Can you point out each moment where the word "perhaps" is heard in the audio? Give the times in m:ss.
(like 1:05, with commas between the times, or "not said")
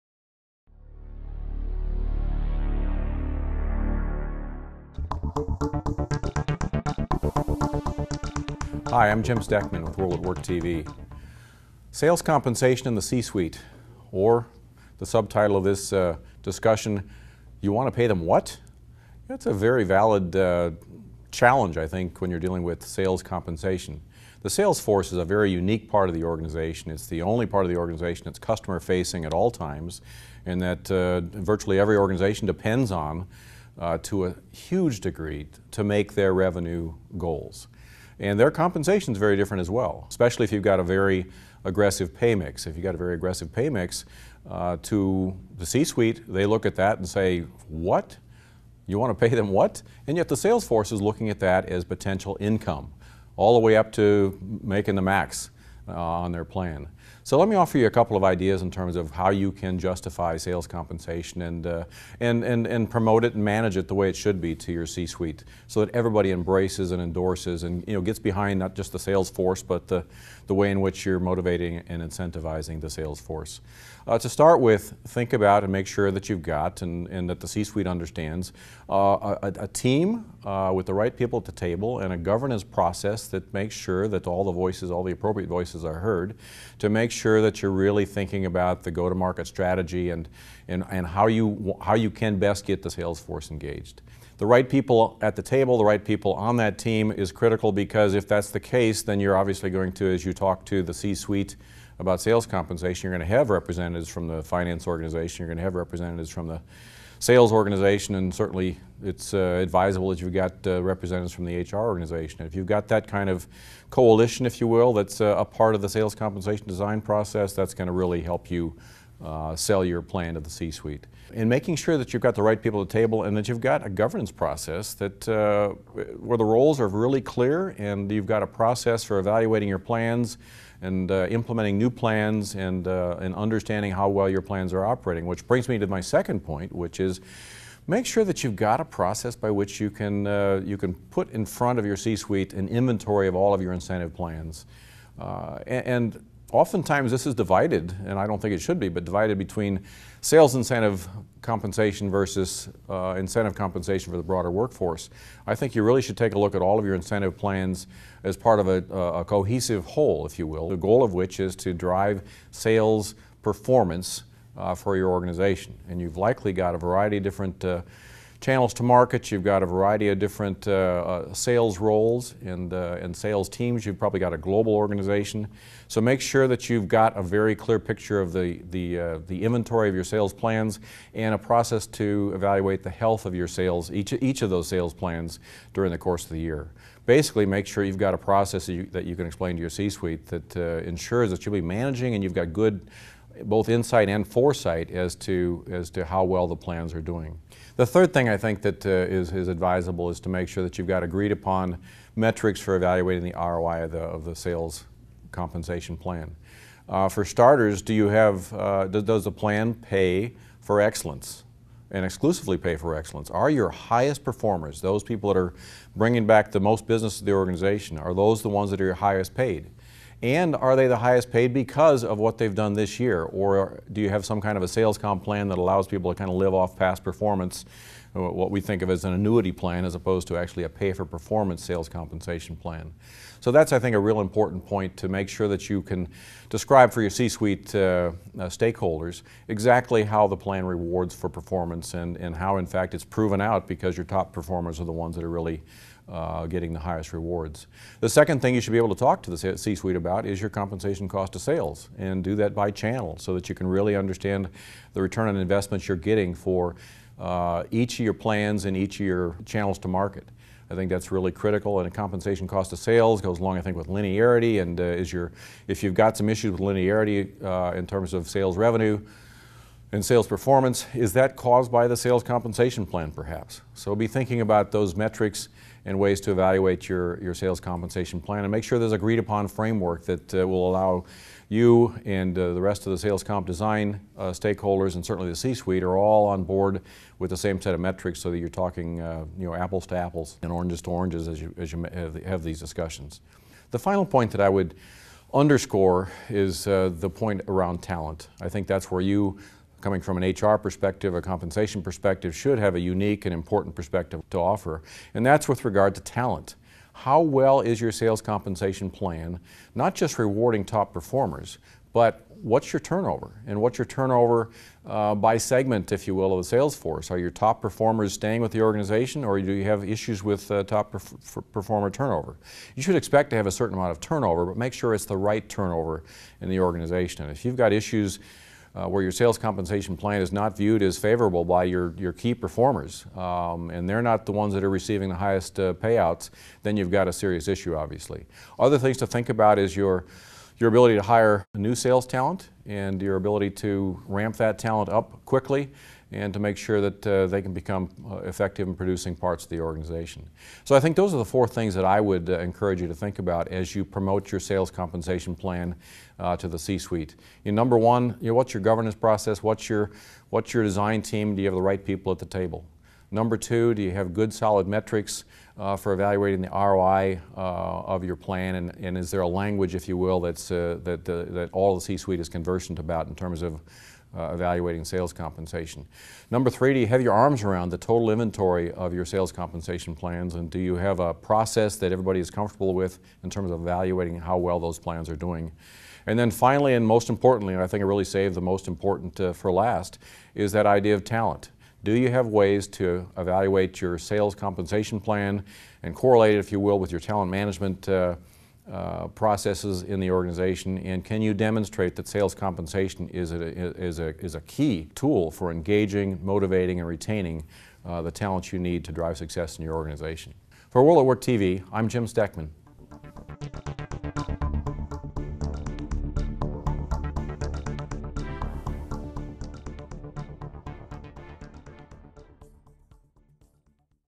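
4:33.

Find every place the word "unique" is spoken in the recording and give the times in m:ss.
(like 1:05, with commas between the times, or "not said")
0:25, 5:02.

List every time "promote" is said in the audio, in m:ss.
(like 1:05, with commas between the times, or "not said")
1:02, 5:53.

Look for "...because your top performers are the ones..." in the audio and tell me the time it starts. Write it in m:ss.
4:03.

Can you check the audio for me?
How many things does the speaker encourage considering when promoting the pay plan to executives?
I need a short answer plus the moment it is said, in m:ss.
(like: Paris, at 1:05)
4, at 5:51.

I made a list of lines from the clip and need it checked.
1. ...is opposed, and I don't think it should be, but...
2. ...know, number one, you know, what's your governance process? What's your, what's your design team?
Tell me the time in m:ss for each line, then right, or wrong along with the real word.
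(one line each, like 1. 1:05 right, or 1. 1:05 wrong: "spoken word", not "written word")
1. 2:27 wrong: "divided", not "opposed"
2. 5:57 right.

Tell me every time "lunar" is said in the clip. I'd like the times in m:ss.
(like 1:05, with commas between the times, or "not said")
not said.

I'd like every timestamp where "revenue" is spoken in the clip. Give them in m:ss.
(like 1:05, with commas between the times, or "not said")
0:36, 4:28.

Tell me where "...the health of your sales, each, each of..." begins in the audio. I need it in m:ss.
3:02.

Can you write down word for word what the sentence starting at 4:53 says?
The final point that I would underscore is uh, the point around talent.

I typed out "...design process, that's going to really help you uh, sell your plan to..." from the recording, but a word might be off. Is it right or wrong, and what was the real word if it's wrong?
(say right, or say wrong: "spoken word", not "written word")
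right.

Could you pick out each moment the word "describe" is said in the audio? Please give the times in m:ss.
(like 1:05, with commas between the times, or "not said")
3:56.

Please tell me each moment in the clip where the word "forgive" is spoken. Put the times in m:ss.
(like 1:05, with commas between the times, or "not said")
not said.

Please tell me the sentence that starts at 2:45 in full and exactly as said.
And you've likely got a variety of different uh, channels to market.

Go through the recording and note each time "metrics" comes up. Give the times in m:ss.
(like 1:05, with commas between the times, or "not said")
3:22, 4:34, 4:47, 6:04.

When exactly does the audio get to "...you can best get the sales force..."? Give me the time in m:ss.
1:31.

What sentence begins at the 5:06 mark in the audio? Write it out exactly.
How well is your sales compensation plan, not just rewarding top performers, but what's your turnover?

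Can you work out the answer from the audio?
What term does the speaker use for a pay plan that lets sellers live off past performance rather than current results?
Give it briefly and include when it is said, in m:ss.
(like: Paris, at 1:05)
annuity plan, at 3:49.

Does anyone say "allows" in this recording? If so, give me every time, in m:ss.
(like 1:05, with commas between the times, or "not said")
3:45, 4:40.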